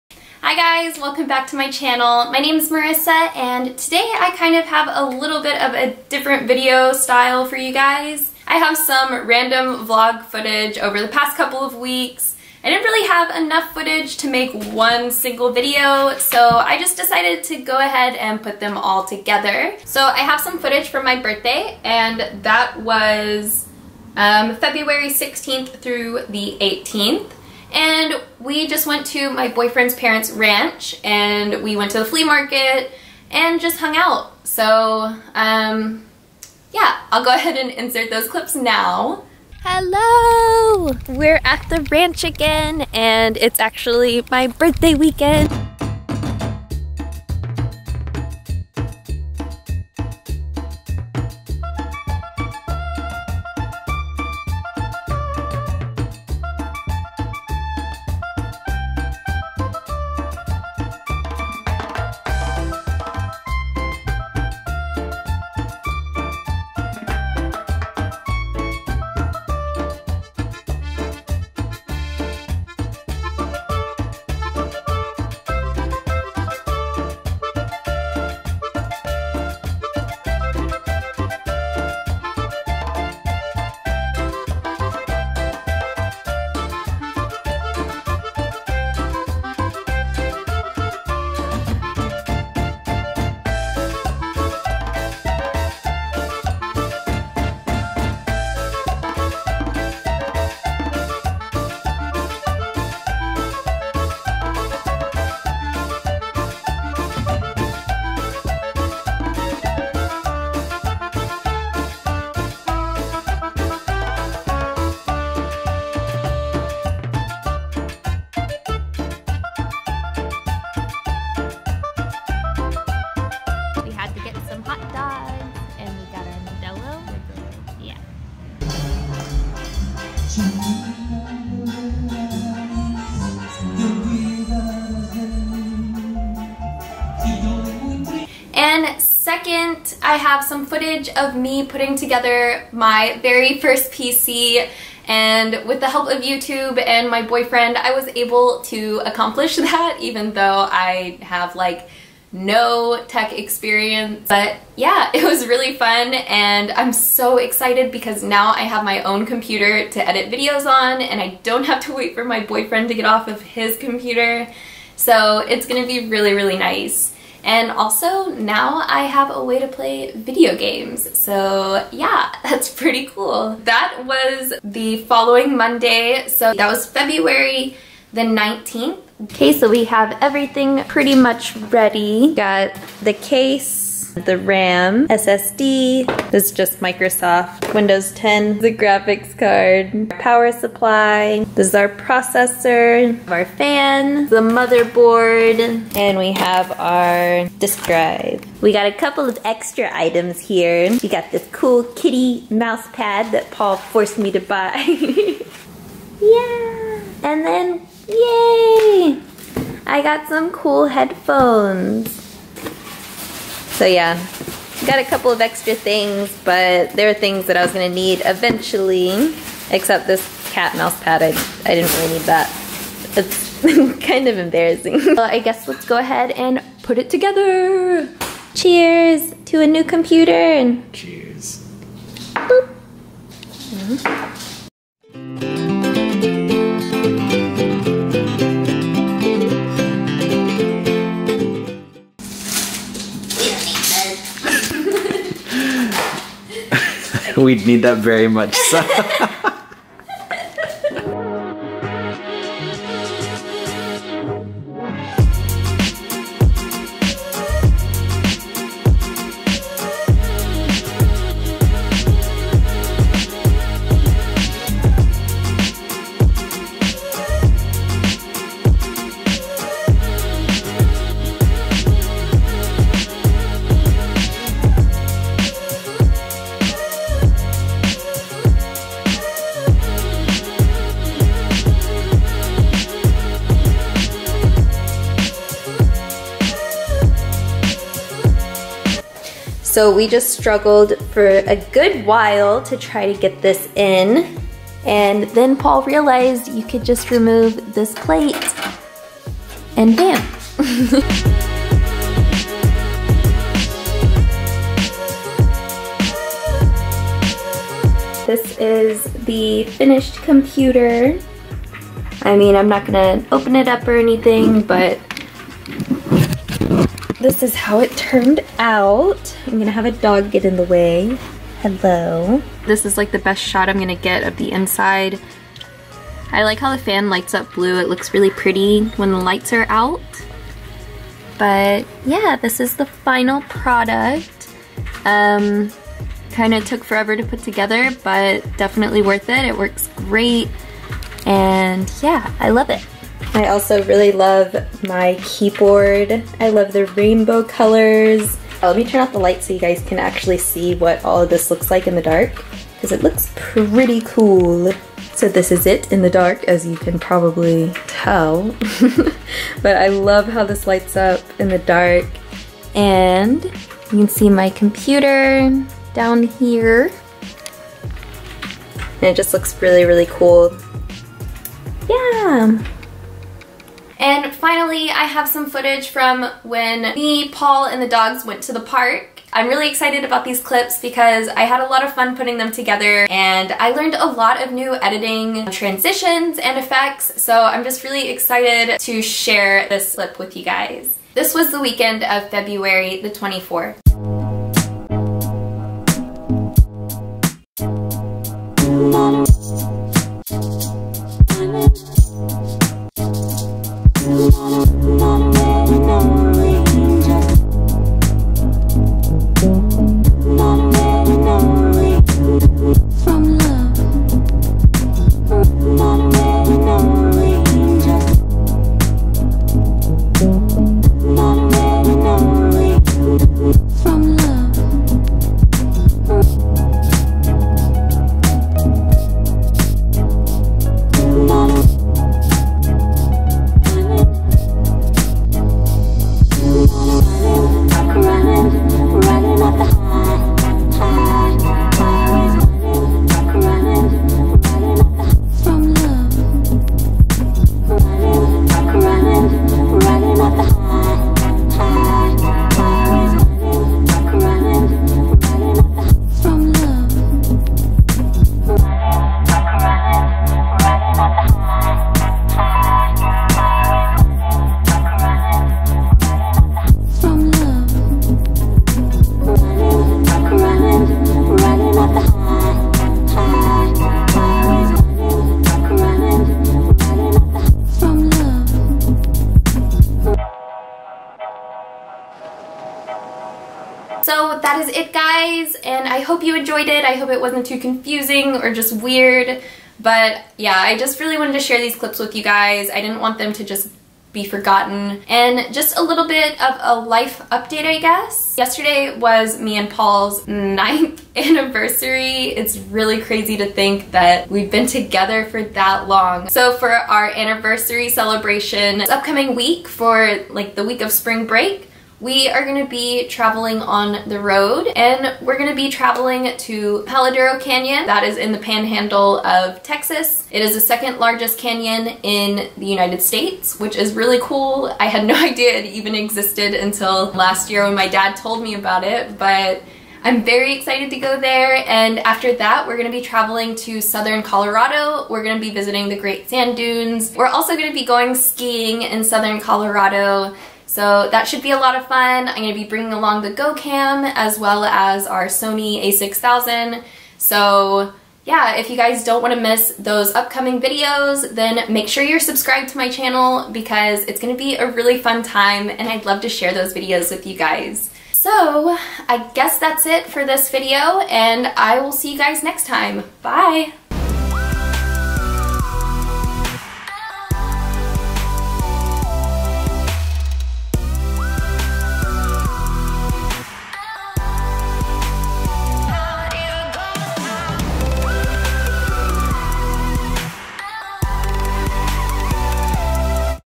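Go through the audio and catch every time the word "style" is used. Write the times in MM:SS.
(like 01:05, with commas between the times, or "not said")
00:06.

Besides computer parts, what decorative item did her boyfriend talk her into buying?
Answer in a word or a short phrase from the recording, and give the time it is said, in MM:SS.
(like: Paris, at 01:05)
kitty mouse pad, at 03:21.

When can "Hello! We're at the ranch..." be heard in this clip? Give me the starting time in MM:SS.
00:39.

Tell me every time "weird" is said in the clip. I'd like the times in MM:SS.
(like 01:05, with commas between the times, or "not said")
08:08.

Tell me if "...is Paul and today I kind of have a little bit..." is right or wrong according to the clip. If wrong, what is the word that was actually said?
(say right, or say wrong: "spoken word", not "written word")
wrong: "Marissa", not "Paul".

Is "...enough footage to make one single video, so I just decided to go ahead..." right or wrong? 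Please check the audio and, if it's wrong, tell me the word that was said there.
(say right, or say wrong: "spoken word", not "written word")
right.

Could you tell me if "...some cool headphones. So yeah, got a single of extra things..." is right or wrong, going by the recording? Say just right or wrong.
wrong.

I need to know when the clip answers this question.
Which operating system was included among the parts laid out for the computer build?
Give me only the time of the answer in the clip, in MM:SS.
03:07.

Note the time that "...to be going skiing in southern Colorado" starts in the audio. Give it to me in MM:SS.
08:57.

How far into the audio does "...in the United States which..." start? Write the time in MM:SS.
08:42.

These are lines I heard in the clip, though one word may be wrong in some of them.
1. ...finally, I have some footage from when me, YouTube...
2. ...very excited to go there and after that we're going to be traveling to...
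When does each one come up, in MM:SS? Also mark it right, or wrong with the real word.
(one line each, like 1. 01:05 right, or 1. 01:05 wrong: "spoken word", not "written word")
1. 06:14 wrong: "Paul", not "YouTube"
2. 08:50 right.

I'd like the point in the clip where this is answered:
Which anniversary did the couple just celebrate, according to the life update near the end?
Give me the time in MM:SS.
08:20.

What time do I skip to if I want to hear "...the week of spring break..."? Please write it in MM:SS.
08:30.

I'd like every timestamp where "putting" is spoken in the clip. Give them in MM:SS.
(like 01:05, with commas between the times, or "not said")
02:21, 06:22.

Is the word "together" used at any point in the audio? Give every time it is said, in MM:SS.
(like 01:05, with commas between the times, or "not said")
00:19, 02:21, 03:47, 05:37, 06:22, 08:24.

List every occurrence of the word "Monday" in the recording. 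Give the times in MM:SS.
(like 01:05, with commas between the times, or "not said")
02:55.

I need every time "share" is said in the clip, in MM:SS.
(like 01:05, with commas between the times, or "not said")
06:29, 08:11, 09:16.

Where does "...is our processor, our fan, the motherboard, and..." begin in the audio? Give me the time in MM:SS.
03:11.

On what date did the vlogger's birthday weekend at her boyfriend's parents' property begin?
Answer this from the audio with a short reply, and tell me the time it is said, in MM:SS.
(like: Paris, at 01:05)
February 16th, at 00:24.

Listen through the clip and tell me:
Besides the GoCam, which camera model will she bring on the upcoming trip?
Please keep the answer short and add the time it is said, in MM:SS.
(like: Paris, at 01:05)
Sony a6000, at 09:05.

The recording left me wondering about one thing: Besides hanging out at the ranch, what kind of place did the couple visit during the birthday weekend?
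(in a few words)
flea market.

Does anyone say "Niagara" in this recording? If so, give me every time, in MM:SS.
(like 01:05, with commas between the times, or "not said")
not said.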